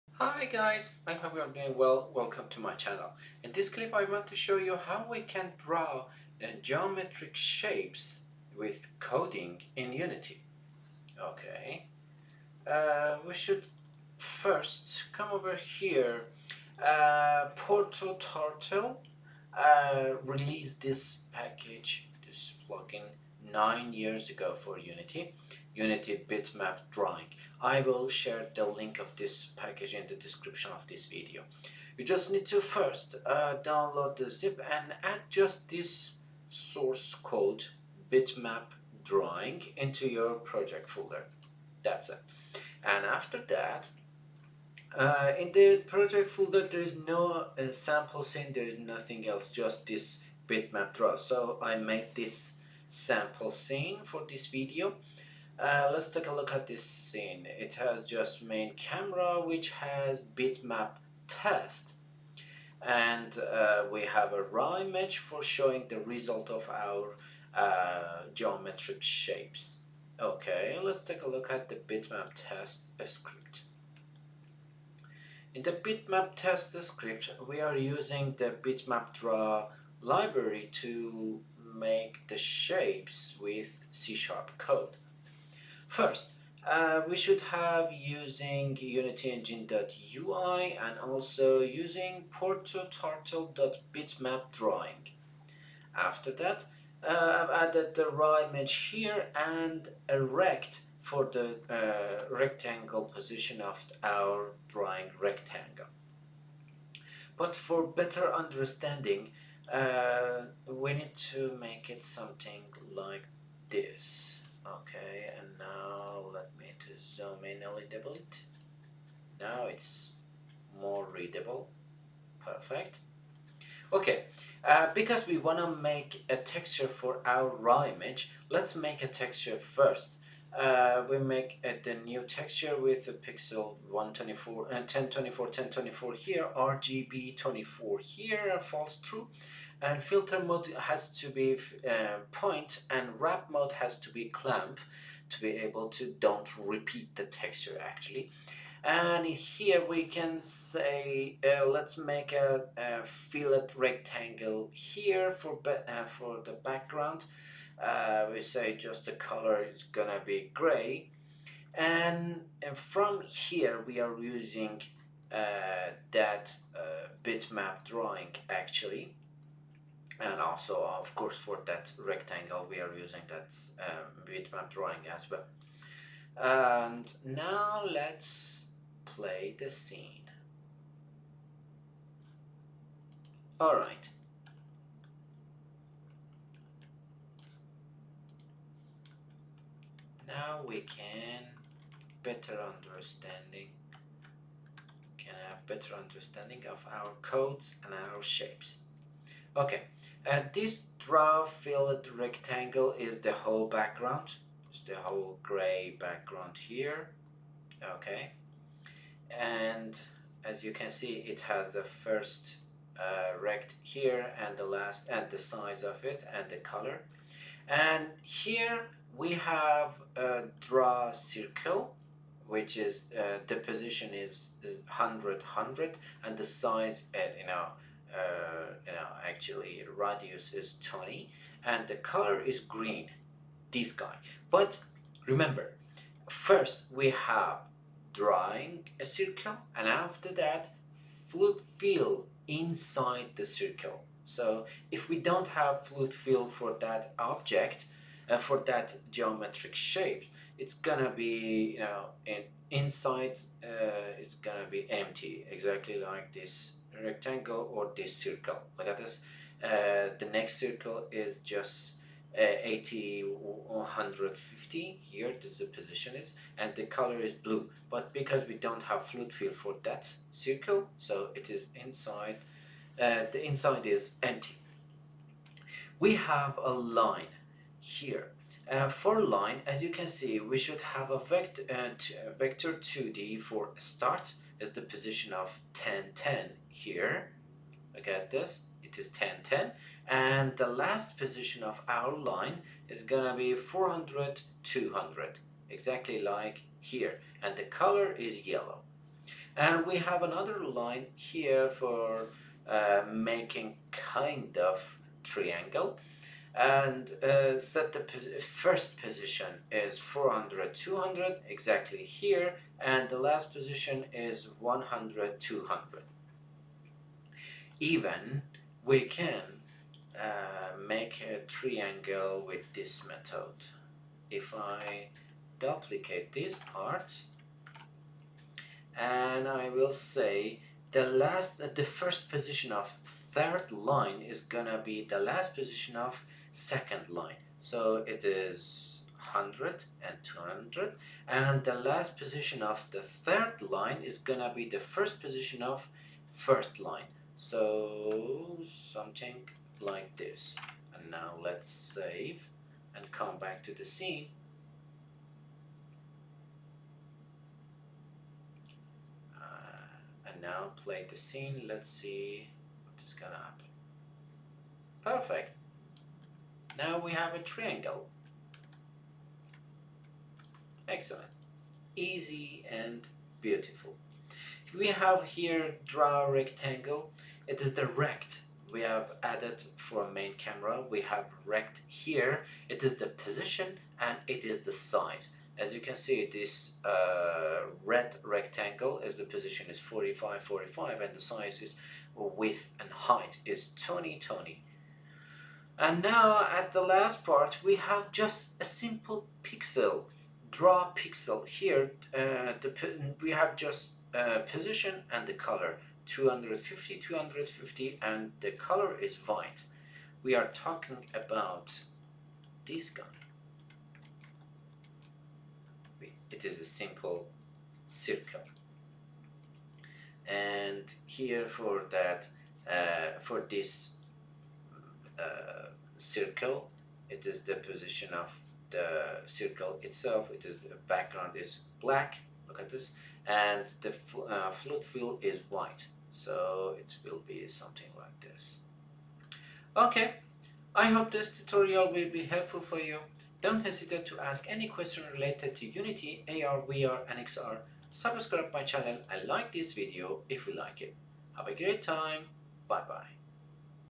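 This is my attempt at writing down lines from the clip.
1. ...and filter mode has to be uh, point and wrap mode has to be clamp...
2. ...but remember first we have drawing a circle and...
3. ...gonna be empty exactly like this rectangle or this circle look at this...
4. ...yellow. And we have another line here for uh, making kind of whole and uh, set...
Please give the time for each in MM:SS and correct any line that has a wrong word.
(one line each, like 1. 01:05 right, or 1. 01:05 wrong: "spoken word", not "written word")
1. 02:19 right
2. 03:54 right
3. 04:14 right
4. 04:58 wrong: "triangle", not "whole".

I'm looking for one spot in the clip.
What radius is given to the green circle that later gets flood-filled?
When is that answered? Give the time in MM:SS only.
03:49.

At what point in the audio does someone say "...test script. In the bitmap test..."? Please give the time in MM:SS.
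01:12.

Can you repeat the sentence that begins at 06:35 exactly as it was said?
And now at the last part, we have just a simple pixel, draw pixel here.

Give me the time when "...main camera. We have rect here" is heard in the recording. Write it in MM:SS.
06:20.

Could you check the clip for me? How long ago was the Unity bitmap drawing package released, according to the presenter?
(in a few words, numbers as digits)
9 years ago.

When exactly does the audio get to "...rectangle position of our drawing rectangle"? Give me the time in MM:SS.
01:42.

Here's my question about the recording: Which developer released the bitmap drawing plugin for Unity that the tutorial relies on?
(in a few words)
ProtoTurtle.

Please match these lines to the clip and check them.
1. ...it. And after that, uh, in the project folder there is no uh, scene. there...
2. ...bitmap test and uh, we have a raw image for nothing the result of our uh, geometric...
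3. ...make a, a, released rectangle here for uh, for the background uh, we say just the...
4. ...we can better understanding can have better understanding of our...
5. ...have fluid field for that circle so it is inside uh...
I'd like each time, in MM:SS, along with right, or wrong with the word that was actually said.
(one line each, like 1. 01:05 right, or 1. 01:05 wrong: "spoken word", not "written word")
1. 00:42 right
2. 01:00 wrong: "showing", not "nothing"
3. 02:31 wrong: "filled", not "released"
4. 03:10 right
5. 04:28 right.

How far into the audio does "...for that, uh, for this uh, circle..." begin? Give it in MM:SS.
07:01.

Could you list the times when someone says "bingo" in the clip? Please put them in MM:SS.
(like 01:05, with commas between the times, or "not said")
not said.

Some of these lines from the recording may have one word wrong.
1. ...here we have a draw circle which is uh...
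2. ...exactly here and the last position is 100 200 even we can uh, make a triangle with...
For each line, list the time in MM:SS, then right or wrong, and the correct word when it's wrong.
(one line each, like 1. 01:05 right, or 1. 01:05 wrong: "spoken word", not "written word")
1. 03:38 right
2. 05:11 right.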